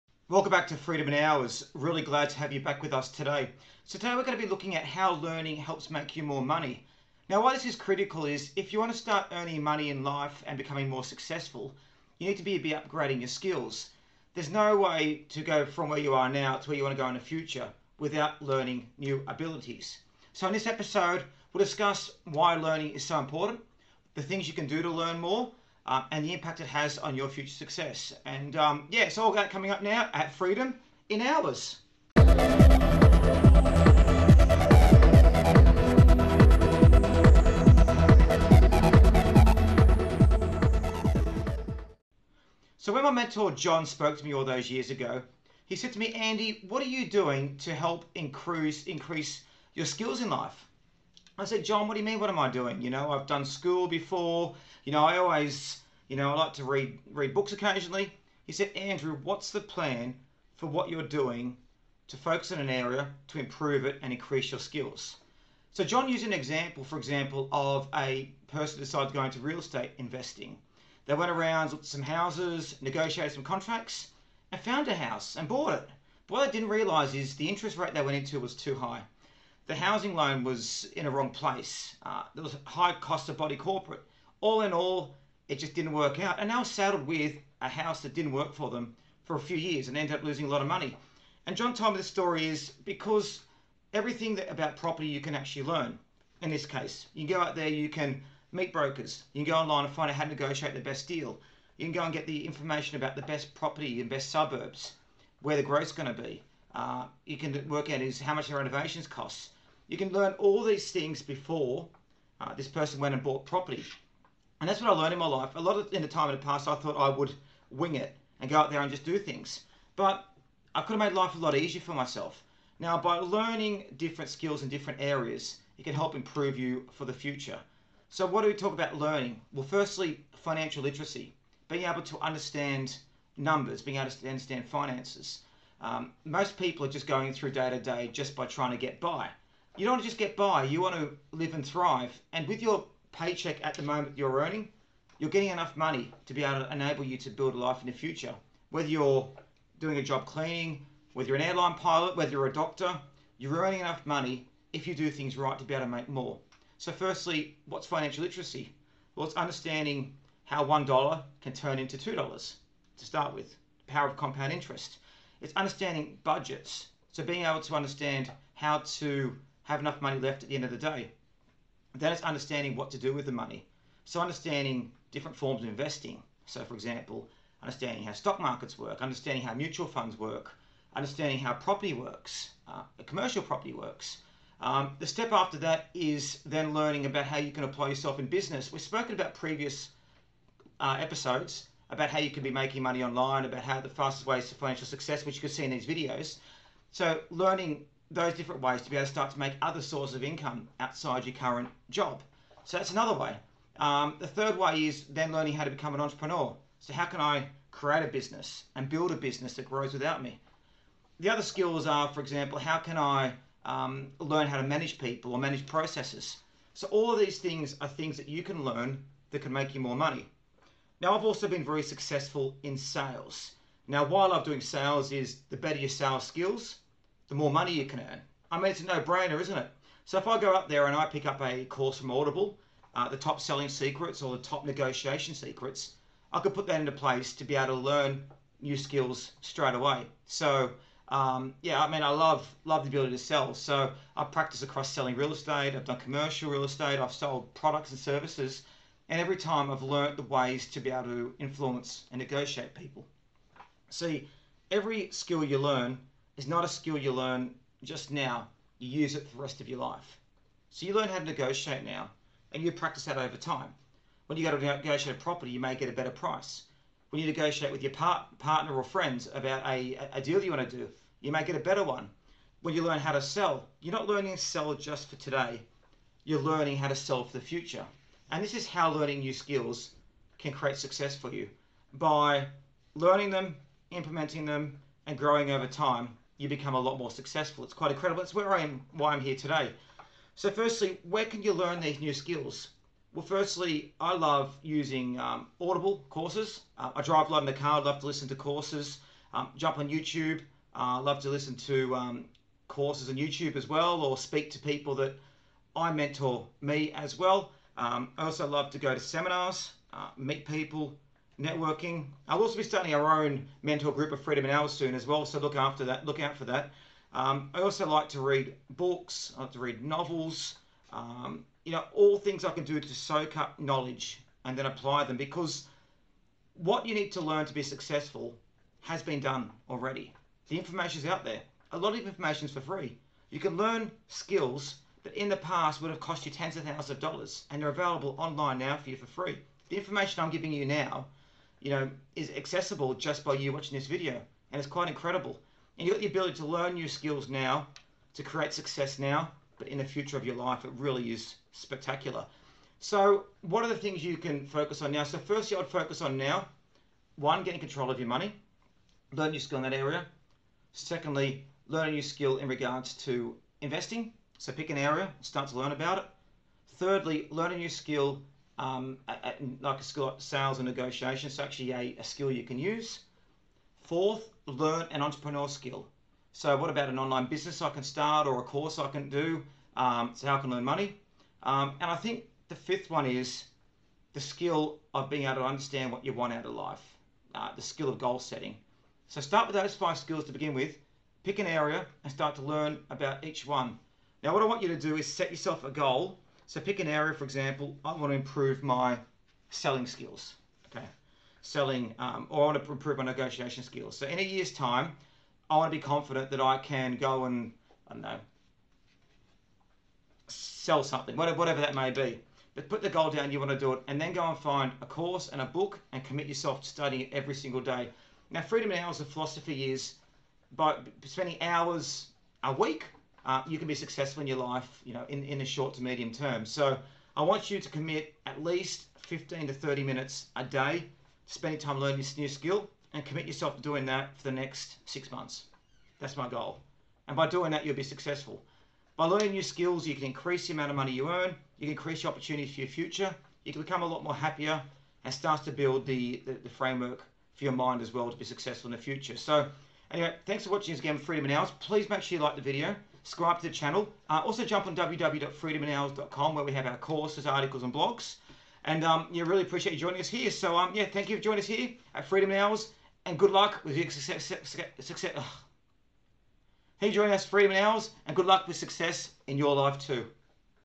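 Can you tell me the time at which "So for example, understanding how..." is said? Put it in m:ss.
2:56.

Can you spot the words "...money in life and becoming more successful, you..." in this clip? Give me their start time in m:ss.
0:09.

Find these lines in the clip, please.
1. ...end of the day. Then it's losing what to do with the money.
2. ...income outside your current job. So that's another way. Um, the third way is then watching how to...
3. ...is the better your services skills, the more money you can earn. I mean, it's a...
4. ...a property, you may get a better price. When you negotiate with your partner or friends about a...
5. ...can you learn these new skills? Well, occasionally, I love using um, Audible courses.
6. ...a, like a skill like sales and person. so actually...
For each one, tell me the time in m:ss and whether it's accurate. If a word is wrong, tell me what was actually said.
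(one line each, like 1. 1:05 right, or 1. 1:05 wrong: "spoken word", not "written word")
1. 2:50 wrong: "understanding", not "losing"
2. 3:20 wrong: "learning", not "watching"
3. 3:45 wrong: "sales", not "services"
4. 4:25 right
5. 4:51 wrong: "firstly", not "occasionally"
6. 6:09 wrong: "negotiation", not "person".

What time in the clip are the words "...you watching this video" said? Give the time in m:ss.
5:43.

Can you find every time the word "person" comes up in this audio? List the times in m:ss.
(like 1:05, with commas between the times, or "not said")
1:08, 1:52.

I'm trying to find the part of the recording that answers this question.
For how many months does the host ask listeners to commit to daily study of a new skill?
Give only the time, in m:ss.
7:14.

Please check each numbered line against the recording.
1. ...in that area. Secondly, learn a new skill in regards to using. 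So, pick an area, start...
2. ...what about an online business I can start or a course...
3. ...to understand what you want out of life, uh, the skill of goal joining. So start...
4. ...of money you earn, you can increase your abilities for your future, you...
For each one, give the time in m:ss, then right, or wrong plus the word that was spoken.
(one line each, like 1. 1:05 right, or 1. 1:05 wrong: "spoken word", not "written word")
1. 5:59 wrong: "investing", not "using"
2. 6:16 right
3. 6:25 wrong: "setting", not "joining"
4. 7:20 wrong: "opportunities", not "abilities".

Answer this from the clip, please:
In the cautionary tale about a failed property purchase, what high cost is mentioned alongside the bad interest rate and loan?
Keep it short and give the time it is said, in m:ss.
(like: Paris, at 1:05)
Body corporate, at 1:23.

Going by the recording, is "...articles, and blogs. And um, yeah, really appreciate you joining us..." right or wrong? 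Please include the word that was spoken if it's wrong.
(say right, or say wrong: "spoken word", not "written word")
right.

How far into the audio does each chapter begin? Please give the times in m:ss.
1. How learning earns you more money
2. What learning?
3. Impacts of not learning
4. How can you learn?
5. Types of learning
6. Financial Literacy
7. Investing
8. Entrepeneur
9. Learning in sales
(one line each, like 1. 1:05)
1. 0:25
2. 0:45
3. 1:05
4. 1:30
5. 2:10
6. 2:20
7. 2:55
8. 3:10
9. 3:40.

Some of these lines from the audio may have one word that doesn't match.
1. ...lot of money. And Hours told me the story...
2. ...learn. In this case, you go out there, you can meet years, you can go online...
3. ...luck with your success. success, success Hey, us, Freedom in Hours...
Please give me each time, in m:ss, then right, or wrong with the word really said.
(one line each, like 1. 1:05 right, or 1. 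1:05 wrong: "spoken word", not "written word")
1. 1:30 wrong: "John", not "Hours"
2. 1:35 wrong: "brokers", not "years"
3. 7:43 right.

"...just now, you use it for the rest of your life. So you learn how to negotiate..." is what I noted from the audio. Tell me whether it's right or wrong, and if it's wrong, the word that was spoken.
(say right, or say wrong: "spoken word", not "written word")
right.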